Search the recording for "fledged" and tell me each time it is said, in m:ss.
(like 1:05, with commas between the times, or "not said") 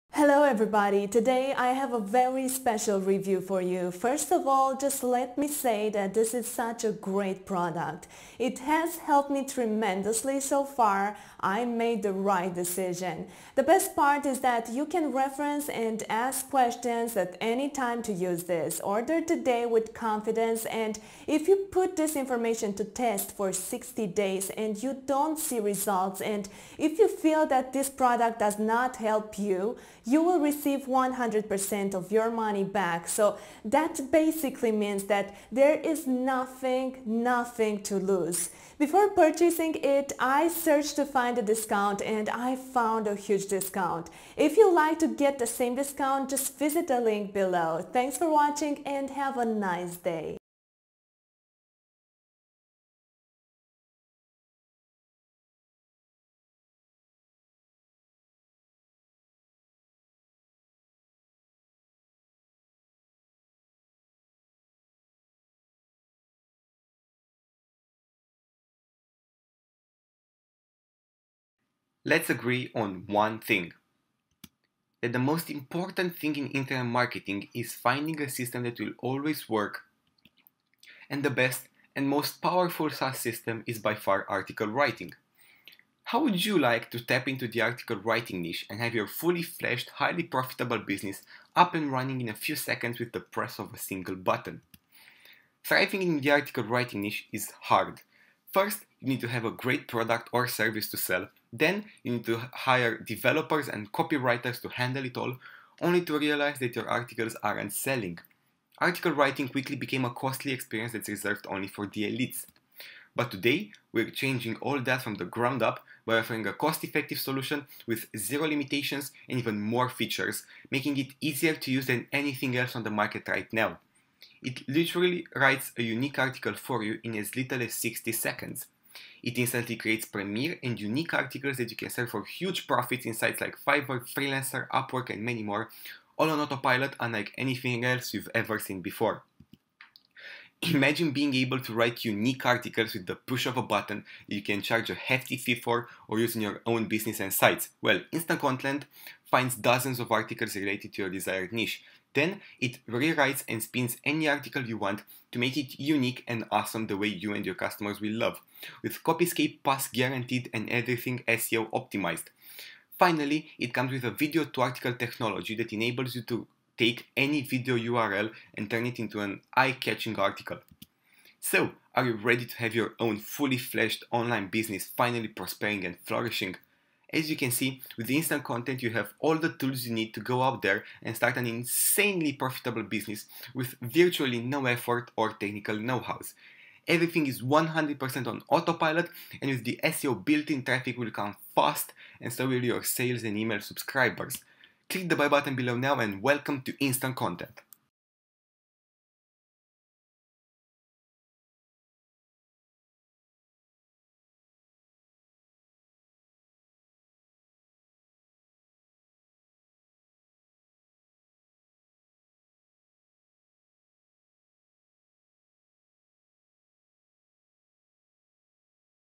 1:29, 2:53.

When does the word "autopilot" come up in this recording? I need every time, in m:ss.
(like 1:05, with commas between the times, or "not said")
2:16, 3:08.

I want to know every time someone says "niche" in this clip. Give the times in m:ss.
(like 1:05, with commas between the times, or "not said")
1:28, 1:37, 2:31.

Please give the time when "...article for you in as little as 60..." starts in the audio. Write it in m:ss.
2:06.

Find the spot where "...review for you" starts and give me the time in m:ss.
0:02.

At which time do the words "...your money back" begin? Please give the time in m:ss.
0:32.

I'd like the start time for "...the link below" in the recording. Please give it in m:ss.
0:46.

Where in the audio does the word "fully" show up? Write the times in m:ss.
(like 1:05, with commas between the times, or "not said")
1:29, 2:53.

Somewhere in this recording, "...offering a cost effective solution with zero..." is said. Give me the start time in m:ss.
1:56.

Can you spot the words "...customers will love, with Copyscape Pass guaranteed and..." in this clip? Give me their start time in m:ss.
2:37.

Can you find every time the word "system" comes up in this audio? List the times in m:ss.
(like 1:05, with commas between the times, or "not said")
1:18, 1:23.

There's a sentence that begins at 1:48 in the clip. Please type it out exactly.
Article writing quickly became a costly experience that's reserved only for the elites.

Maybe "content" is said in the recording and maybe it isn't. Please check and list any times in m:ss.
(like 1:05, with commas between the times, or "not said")
2:28, 2:58, 3:17.